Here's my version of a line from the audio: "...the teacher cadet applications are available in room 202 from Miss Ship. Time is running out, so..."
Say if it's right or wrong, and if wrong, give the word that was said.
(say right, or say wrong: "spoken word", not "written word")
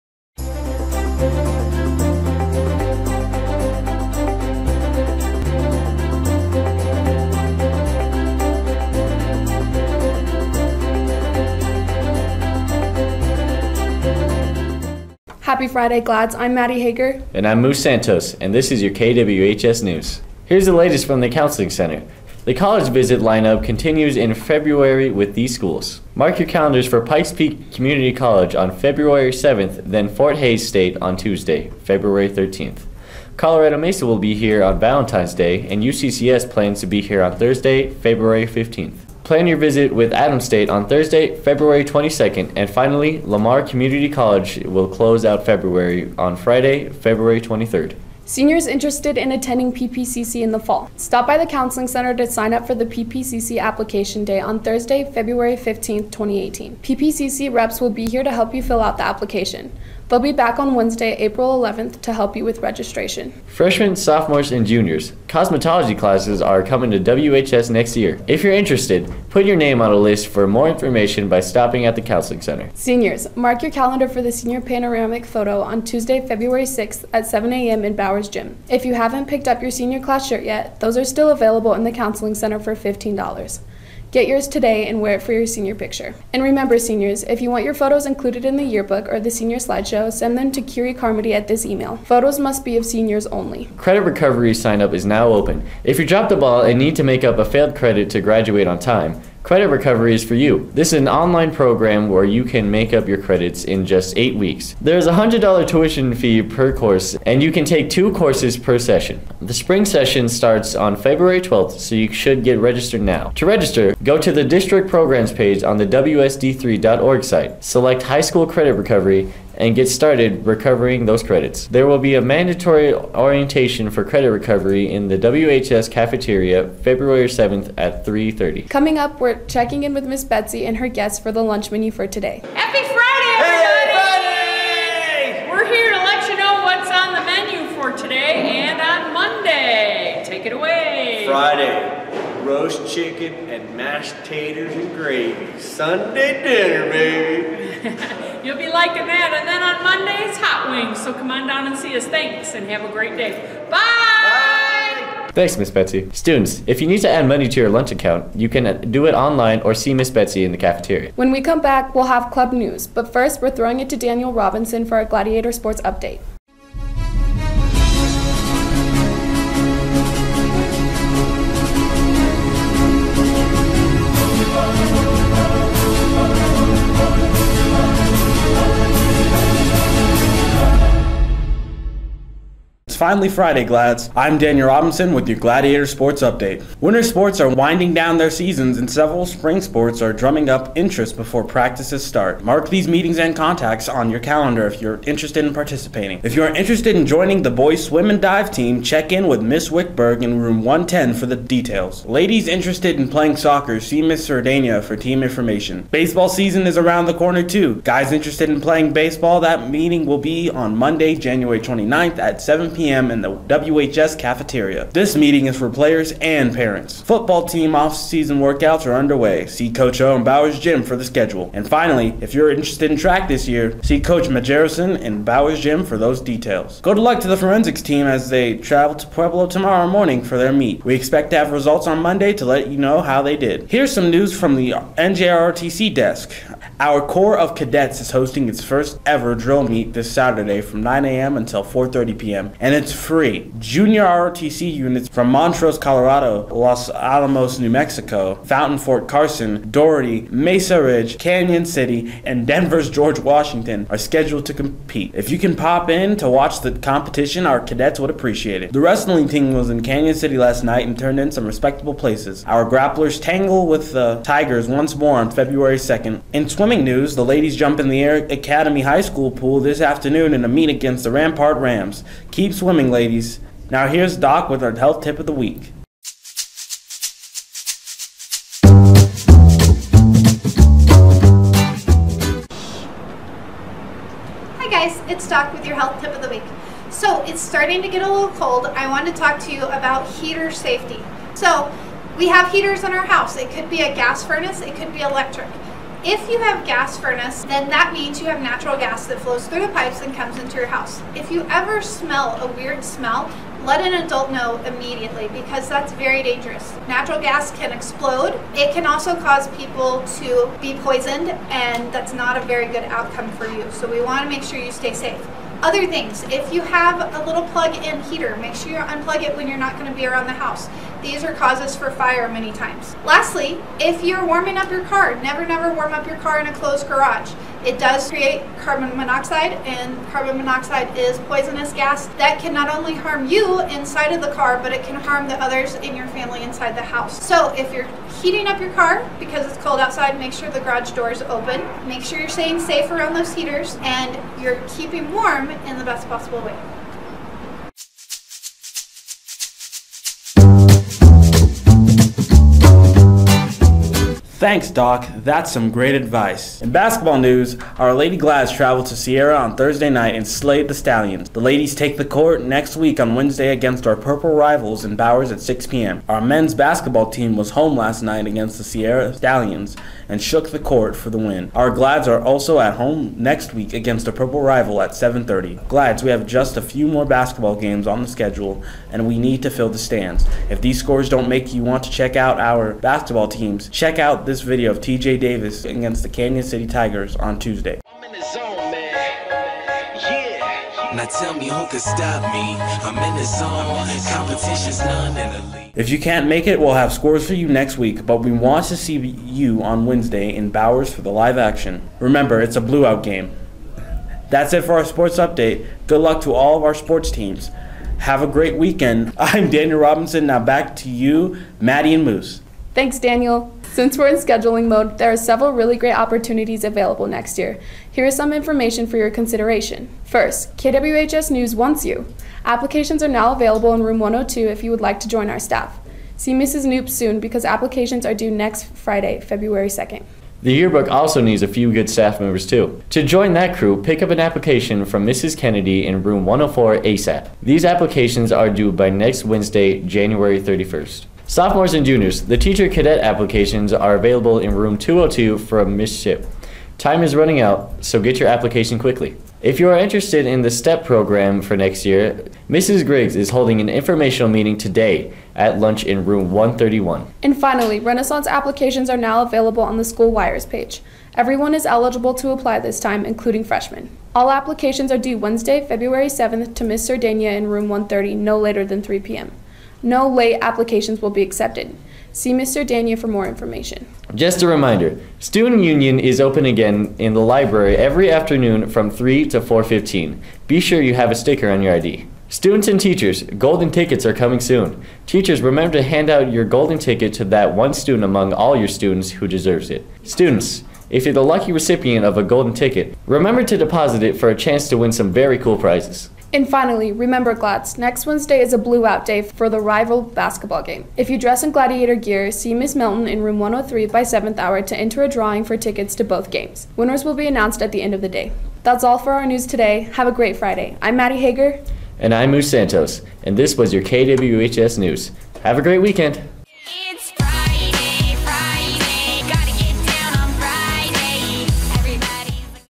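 right.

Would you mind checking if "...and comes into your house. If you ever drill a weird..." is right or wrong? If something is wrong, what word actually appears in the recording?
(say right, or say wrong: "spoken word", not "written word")
wrong: "smell", not "drill".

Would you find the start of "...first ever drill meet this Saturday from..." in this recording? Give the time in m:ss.
3:58.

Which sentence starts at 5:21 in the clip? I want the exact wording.
These are causes for fire many times.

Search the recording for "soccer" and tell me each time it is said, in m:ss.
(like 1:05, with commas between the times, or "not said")
3:23.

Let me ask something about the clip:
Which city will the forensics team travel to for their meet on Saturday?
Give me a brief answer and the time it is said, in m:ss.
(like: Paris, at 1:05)
Pueblo, at 3:49.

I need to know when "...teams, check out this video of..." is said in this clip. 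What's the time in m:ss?
6:23.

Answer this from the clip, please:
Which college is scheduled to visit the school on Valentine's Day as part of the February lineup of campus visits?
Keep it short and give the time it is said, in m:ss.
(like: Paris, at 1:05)
Colorado Mesa, at 0:33.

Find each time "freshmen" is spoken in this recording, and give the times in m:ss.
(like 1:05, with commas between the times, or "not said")
1:03, 7:43.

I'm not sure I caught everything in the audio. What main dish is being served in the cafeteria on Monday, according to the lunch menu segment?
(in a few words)
Hot wings.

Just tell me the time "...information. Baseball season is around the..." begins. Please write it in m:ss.
3:25.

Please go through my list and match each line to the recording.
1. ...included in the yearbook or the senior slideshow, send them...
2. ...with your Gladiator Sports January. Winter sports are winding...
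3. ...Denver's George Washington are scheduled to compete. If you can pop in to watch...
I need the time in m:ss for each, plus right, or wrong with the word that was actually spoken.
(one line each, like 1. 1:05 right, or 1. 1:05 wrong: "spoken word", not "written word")
1. 1:28 right
2. 3:05 wrong: "Update", not "January"
3. 4:12 right.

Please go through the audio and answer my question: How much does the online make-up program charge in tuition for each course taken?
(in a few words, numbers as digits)
$100.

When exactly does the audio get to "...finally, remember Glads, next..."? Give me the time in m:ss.
8:16.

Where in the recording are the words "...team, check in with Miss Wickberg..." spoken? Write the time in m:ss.
3:18.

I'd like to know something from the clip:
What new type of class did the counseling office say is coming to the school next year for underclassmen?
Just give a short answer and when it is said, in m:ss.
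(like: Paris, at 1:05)
Cosmetology, at 1:05.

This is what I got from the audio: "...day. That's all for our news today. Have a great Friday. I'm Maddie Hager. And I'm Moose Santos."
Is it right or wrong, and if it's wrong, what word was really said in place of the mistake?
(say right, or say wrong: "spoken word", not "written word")
right.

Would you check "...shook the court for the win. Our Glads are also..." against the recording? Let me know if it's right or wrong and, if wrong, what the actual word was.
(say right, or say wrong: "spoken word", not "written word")
right.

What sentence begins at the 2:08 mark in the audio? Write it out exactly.
Coming up, we're checking in with Miss Betsy and her guests for the lunch menu for today.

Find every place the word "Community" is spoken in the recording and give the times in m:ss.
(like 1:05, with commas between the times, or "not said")
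0:27, 0:43.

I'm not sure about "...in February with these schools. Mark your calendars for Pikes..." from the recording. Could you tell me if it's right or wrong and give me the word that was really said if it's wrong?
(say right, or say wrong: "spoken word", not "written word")
right.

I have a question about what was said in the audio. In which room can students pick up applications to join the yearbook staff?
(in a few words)
Room 104.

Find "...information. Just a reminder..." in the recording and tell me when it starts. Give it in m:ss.
7:53.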